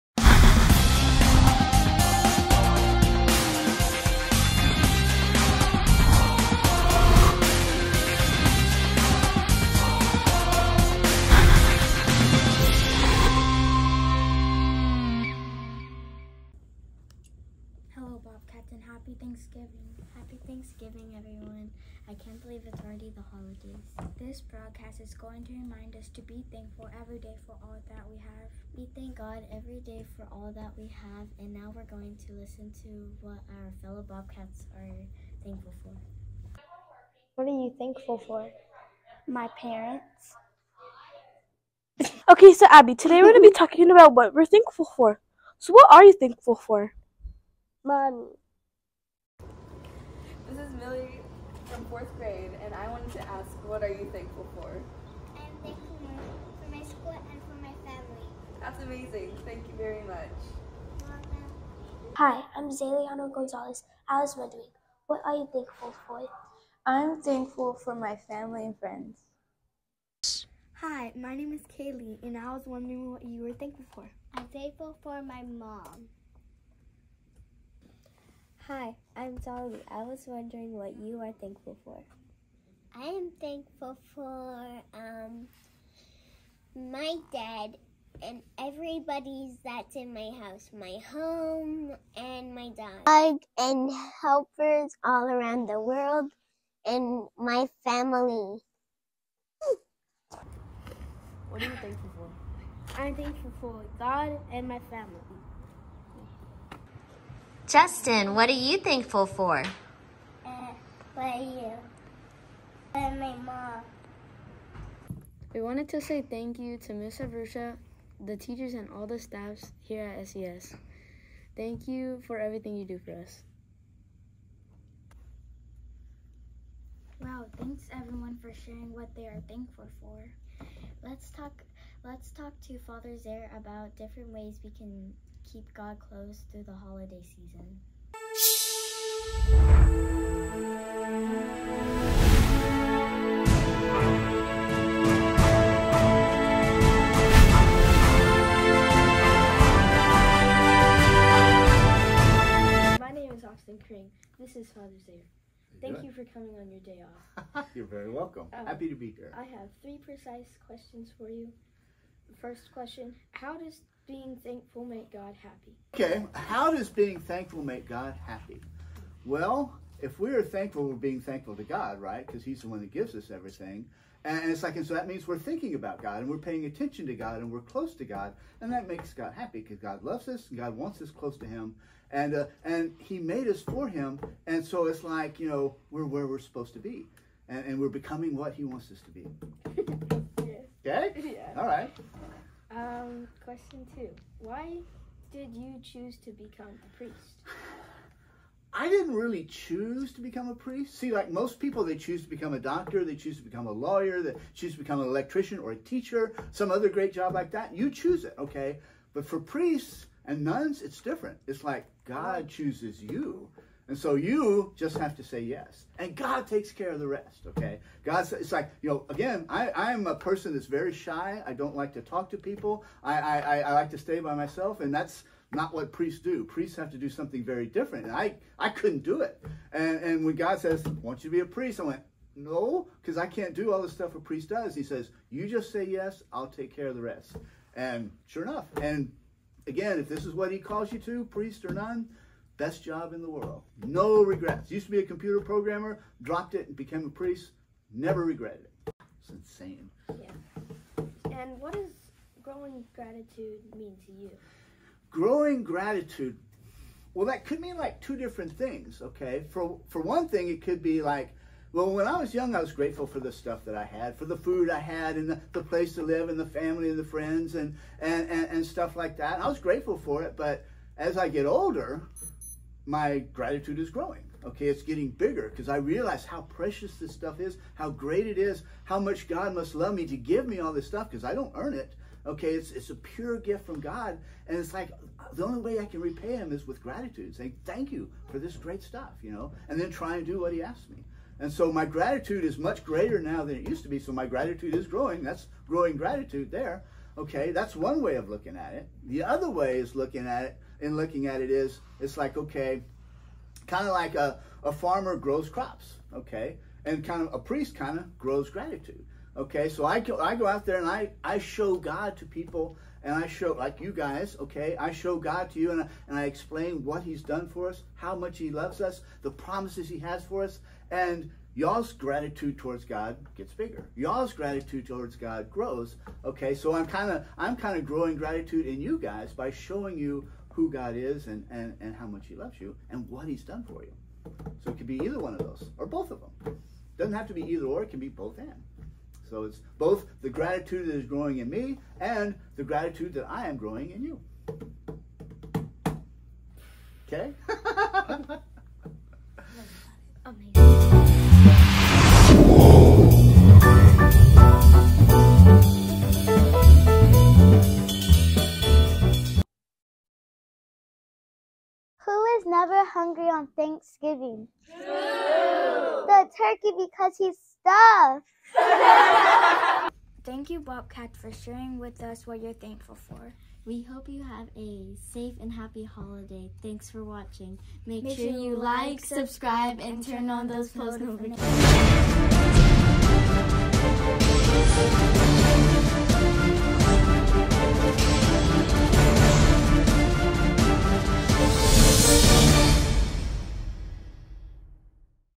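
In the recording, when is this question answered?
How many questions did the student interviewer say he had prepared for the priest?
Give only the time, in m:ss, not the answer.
2:39.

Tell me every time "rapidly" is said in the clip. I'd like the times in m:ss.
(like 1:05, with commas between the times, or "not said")
not said.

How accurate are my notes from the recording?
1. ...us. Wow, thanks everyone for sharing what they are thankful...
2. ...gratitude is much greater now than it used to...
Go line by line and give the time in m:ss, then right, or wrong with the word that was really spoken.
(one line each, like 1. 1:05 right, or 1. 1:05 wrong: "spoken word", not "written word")
1. 2:03 right
2. 4:51 right.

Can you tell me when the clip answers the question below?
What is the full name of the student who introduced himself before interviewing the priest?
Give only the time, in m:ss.
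2:33.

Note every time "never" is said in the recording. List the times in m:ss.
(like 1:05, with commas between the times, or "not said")
4:07, 6:02.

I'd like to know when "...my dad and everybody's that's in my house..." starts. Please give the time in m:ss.
1:26.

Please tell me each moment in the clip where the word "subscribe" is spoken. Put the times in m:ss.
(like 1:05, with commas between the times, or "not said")
6:19.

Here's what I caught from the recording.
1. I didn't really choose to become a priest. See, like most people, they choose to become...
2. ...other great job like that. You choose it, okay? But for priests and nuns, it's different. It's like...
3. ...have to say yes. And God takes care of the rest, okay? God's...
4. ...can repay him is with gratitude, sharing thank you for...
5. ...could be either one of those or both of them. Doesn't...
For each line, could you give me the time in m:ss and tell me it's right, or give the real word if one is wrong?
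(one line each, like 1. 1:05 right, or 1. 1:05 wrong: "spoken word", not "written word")
1. 3:18 right
2. 3:26 right
3. 3:34 right
4. 4:45 wrong: "saying", not "sharing"
5. 5:34 right.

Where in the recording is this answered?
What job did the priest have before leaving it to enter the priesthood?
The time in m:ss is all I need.
4:05.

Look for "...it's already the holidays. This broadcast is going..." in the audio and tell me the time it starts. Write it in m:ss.
0:22.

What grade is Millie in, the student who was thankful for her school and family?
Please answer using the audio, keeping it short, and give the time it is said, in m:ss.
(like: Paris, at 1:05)
Fourth grade, at 0:51.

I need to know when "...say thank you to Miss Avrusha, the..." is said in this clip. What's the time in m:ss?
1:56.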